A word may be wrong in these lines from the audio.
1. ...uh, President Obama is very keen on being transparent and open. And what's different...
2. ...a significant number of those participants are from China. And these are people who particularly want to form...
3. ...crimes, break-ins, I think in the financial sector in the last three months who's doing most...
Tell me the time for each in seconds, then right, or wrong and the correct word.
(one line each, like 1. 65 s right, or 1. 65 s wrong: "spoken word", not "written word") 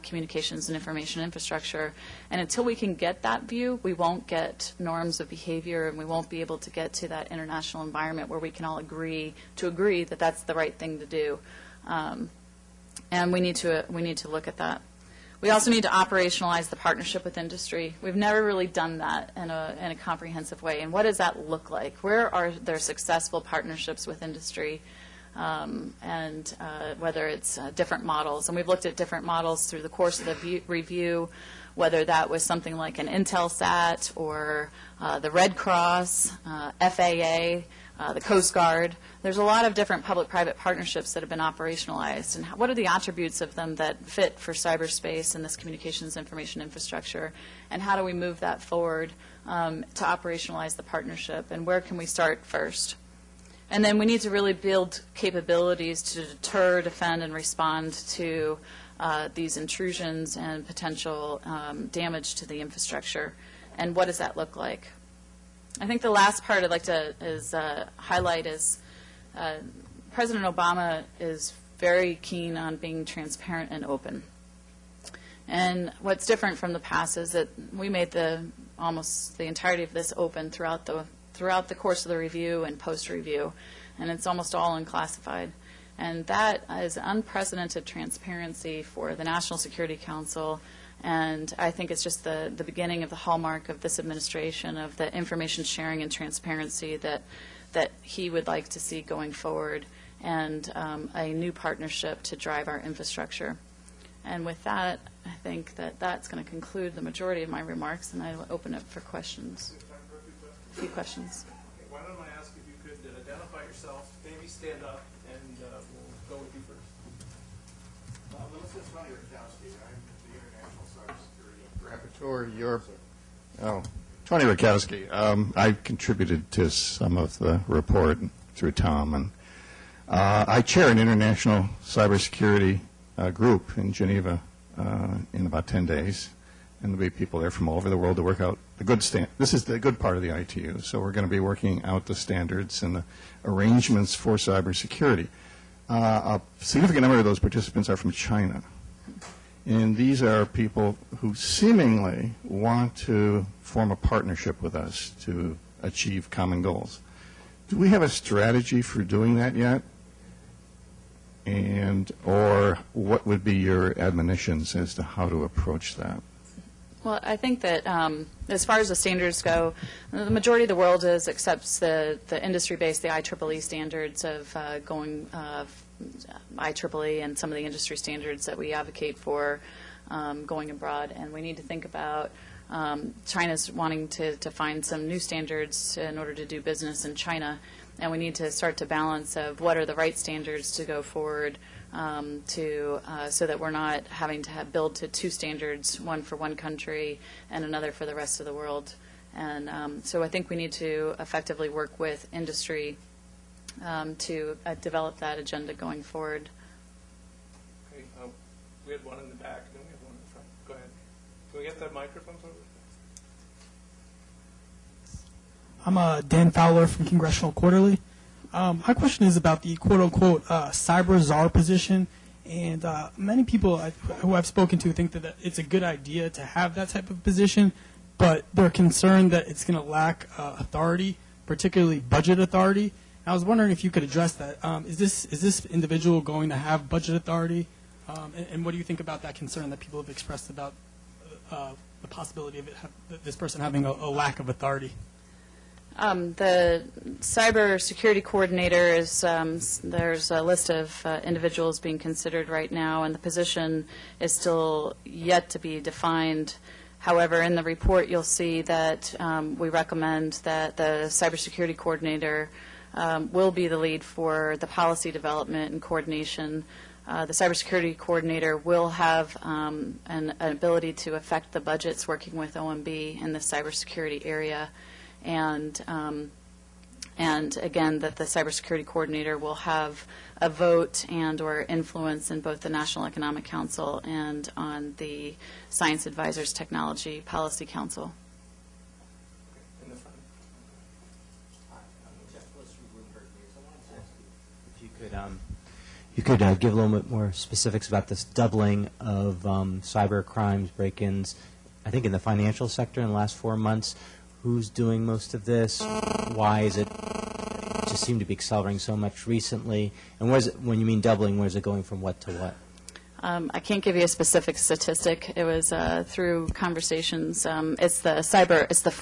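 1. 69 s right
2. 146 s wrong: "seemingly", not "particularly"
3. 300 s wrong: "four", not "three".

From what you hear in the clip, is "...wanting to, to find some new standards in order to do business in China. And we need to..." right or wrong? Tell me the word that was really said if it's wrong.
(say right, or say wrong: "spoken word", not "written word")
right.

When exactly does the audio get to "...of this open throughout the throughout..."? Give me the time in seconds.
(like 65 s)
79 s.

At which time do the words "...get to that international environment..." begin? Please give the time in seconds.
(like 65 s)
6 s.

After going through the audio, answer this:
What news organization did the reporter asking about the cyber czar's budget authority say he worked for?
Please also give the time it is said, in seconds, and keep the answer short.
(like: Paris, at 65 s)
Congressional Quarterly, at 217 s.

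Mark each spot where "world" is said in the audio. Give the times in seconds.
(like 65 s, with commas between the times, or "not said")
137 s, 170 s, 198 s.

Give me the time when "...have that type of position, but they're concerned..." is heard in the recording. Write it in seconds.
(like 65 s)
226 s.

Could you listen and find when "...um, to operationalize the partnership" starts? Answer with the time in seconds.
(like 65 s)
49 s.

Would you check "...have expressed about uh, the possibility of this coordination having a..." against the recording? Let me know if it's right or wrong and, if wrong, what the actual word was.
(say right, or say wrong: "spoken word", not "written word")
wrong: "person", not "coordination".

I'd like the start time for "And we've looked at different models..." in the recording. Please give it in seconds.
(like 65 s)
28 s.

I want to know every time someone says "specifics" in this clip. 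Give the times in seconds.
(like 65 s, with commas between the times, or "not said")
297 s, 314 s.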